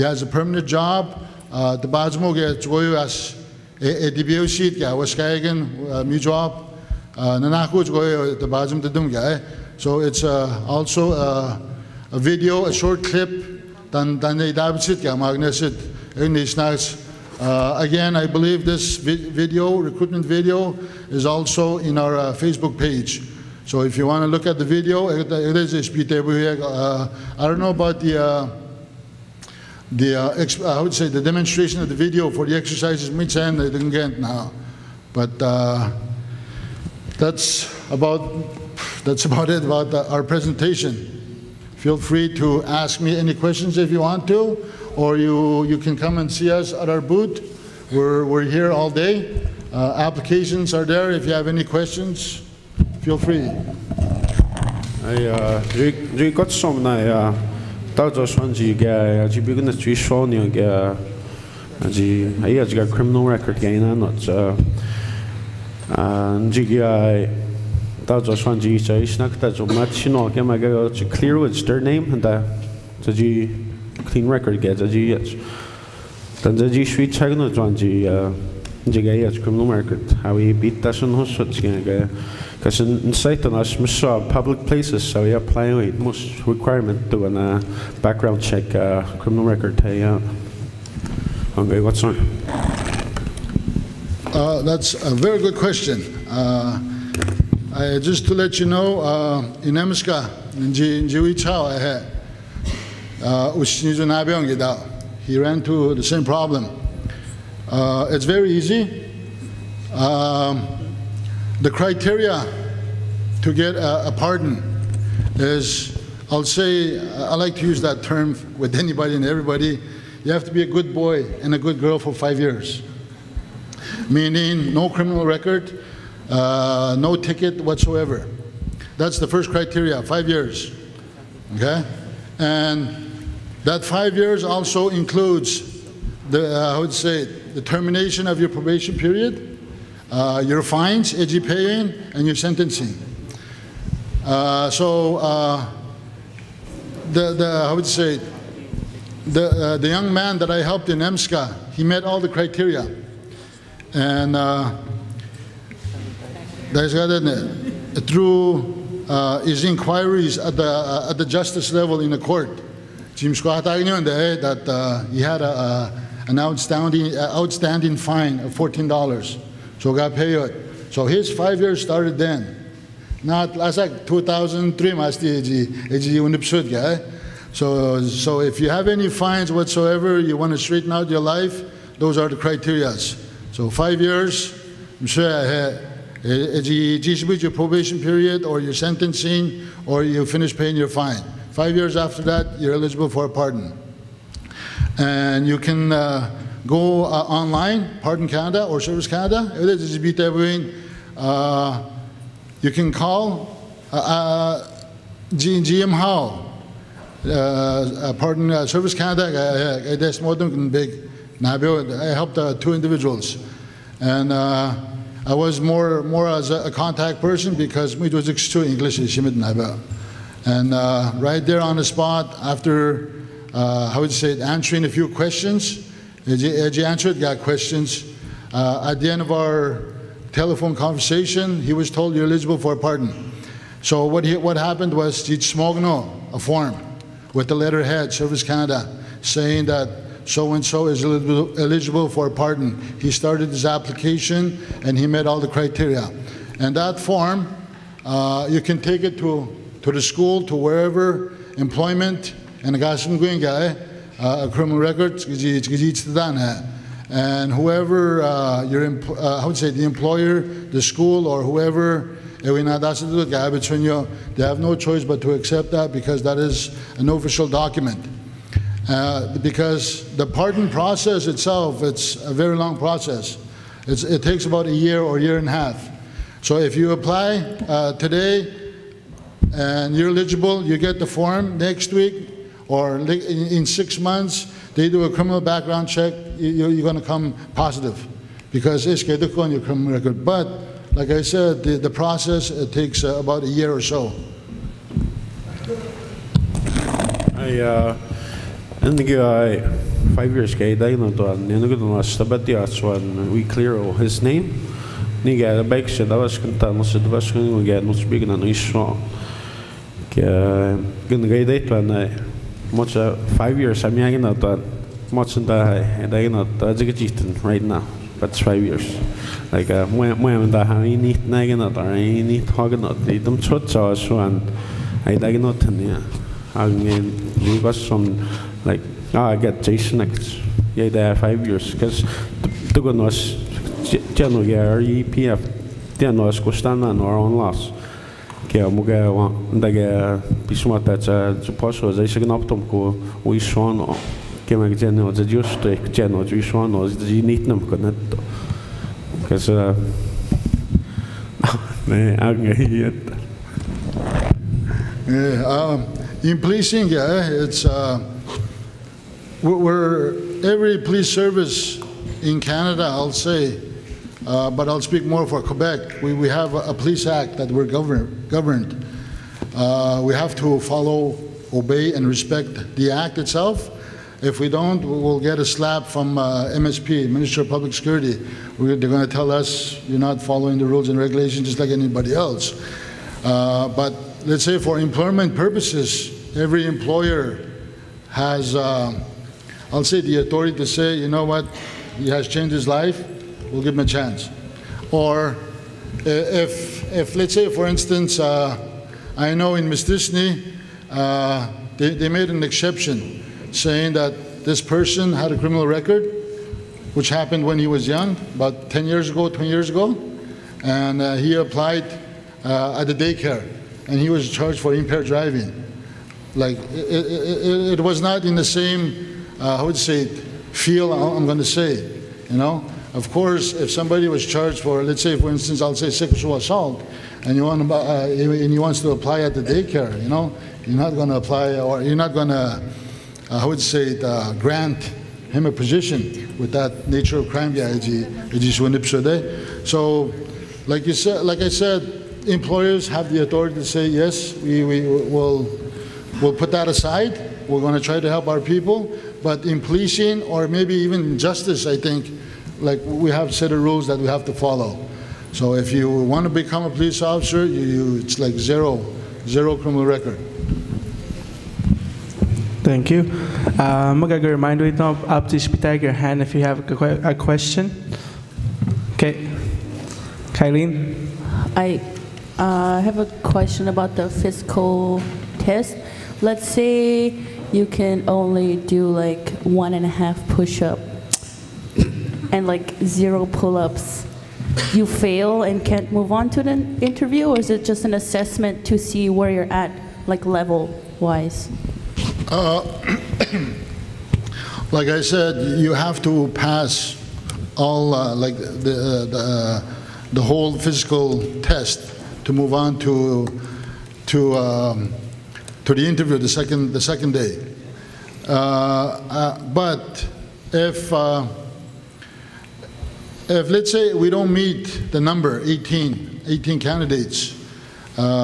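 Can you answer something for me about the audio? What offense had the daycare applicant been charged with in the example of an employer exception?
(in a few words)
impaired driving.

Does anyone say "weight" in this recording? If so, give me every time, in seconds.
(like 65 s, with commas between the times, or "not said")
not said.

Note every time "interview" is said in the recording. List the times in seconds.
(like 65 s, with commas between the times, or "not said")
486 s, 505 s.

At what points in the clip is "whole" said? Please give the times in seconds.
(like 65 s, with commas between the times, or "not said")
500 s.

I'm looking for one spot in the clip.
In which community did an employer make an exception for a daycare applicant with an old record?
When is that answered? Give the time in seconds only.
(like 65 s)
399 s.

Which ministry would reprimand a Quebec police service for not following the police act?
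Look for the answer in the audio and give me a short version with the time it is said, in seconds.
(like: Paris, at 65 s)
Minister of Public Security, at 377 s.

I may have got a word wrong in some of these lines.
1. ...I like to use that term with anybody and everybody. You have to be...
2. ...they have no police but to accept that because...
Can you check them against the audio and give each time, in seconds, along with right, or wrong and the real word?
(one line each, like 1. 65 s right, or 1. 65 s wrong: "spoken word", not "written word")
1. 116 s right
2. 264 s wrong: "choice", not "police".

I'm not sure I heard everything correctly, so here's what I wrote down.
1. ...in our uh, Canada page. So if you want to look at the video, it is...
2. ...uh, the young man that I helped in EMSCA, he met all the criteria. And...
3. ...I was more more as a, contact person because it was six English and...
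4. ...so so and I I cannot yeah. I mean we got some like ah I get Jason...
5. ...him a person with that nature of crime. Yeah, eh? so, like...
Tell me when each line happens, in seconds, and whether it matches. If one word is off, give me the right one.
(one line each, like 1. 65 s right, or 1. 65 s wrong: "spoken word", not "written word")
1. 21 s wrong: "Facebook", not "Canada"
2. 149 s right
3. 214 s wrong: "two", not "six"
4. 323 s right
5. 435 s wrong: "position", not "person".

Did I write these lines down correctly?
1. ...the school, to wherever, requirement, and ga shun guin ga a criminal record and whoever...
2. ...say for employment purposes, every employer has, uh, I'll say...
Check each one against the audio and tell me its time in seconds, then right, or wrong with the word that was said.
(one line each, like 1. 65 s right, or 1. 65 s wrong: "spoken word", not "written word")
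1. 249 s wrong: "employment", not "requirement"
2. 384 s right.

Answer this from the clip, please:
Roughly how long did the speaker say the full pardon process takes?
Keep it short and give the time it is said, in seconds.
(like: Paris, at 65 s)
a year or year and a half, at 274 s.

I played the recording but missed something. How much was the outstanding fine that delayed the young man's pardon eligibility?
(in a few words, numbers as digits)
$14.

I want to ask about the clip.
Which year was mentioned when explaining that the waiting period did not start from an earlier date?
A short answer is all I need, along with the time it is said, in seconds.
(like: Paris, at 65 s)
2003, at 174 s.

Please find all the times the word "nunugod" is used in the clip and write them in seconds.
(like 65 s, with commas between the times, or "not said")
301 s.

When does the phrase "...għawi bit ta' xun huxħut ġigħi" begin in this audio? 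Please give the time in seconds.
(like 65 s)
80 s.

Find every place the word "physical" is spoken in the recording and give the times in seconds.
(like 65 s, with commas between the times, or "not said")
474 s, 500 s.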